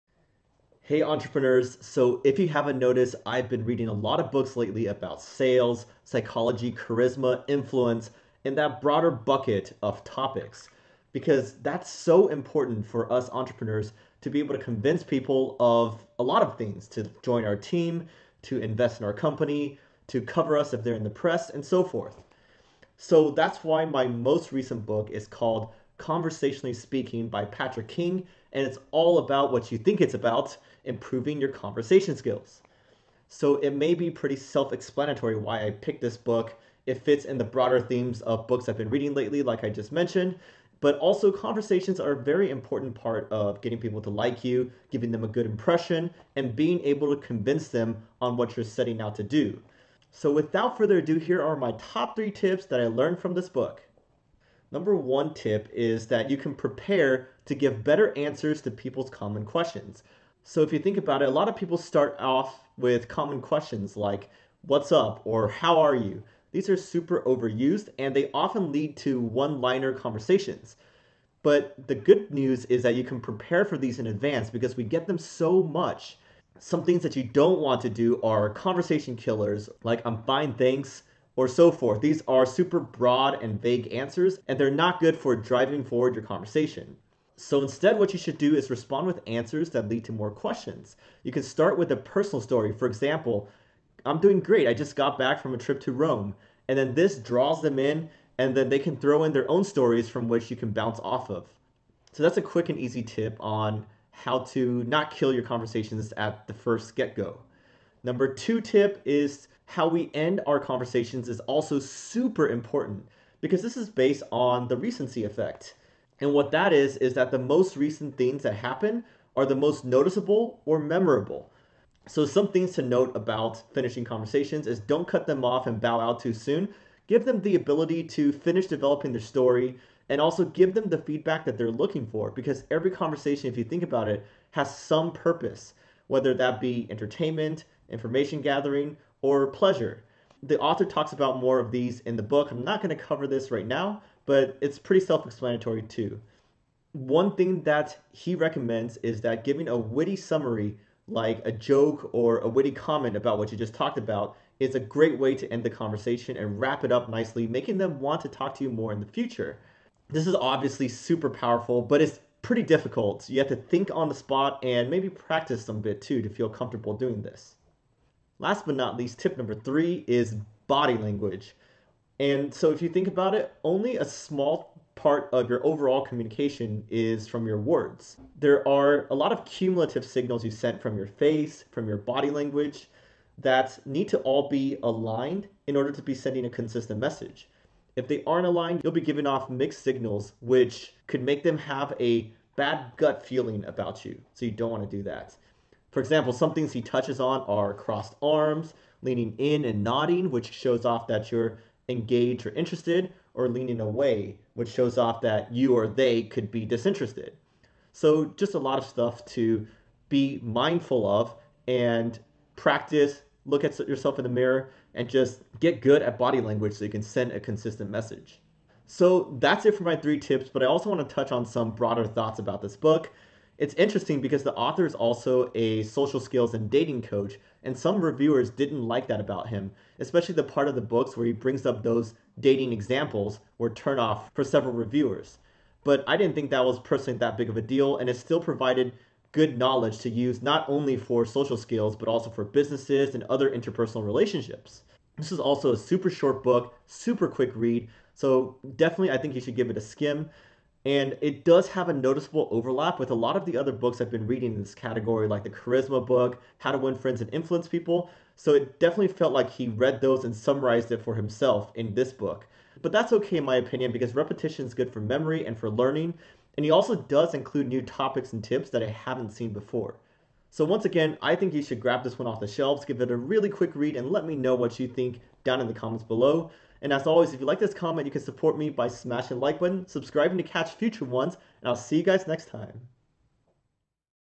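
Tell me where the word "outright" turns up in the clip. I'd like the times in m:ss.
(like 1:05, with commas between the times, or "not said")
not said.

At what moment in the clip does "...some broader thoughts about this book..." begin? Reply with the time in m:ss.
3:41.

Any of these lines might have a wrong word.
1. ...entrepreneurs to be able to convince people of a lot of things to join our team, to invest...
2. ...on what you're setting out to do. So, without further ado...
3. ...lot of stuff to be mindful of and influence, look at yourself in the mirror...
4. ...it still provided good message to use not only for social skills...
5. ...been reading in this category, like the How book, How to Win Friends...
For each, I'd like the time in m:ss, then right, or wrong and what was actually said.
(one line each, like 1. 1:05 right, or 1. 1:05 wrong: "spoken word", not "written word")
1. 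0:13 right
2. 0:48 right
3. 3:28 wrong: "practice", not "influence"
4. 3:58 wrong: "knowledge", not "message"
5. 4:14 wrong: "Charisma", not "How".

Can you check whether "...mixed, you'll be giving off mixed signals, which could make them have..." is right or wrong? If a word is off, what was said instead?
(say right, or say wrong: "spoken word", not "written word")
wrong: "aligned", not "mixed".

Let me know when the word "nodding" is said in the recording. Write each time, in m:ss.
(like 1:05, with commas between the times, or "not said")
3:19.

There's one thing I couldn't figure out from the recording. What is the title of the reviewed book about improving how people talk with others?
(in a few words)
Conversationally Speaking.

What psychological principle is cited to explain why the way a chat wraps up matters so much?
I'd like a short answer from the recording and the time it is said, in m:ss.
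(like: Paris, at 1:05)
recency effect, at 1:54.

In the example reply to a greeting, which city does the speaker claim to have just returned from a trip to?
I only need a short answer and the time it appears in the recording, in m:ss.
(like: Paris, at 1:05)
Rome, at 1:35.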